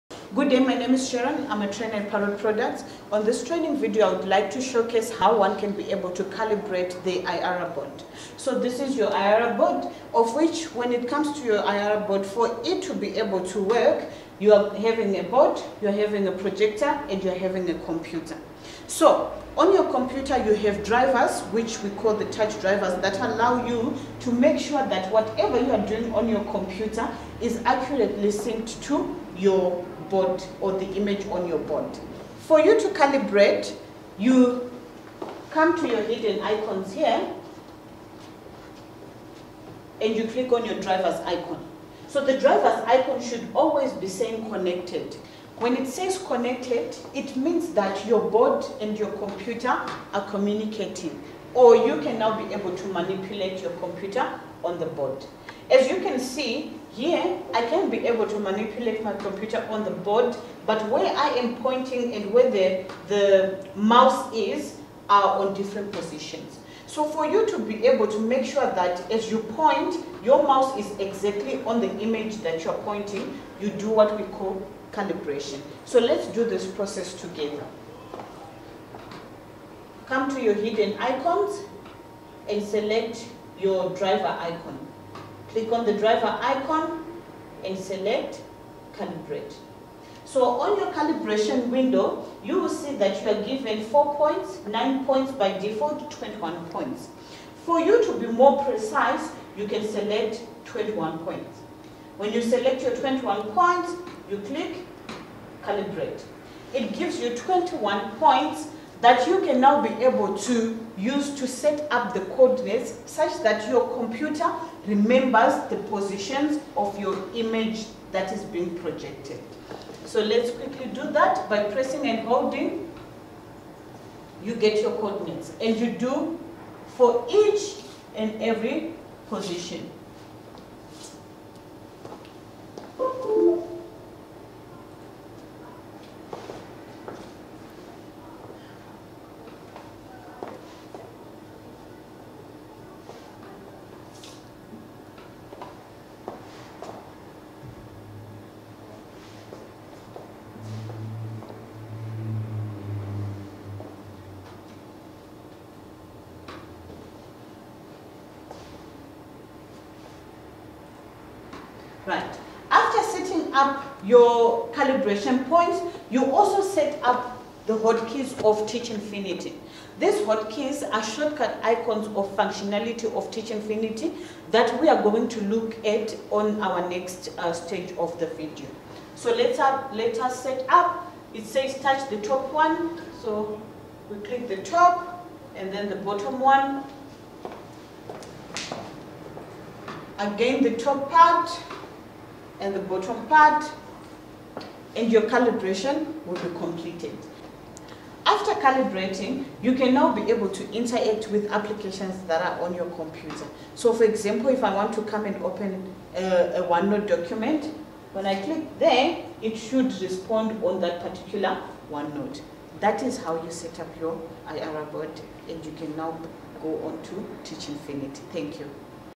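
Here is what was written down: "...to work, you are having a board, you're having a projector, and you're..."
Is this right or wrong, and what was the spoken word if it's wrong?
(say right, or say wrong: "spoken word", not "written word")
right.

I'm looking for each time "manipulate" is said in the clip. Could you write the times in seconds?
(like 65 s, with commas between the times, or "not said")
52 s, 58 s.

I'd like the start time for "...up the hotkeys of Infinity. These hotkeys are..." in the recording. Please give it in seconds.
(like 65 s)
167 s.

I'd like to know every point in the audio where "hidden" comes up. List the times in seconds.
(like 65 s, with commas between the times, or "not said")
36 s, 80 s.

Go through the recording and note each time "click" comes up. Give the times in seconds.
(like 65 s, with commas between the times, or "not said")
40 s, 85 s, 104 s, 184 s, 208 s.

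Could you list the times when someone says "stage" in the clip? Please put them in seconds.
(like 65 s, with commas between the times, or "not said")
177 s.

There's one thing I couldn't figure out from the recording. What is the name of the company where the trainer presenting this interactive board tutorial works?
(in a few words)
Parrot Products.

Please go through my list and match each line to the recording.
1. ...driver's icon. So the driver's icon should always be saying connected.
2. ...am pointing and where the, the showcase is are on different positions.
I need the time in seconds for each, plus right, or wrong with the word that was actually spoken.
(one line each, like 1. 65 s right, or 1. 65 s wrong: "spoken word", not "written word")
1. 40 s right
2. 61 s wrong: "mouse", not "showcase".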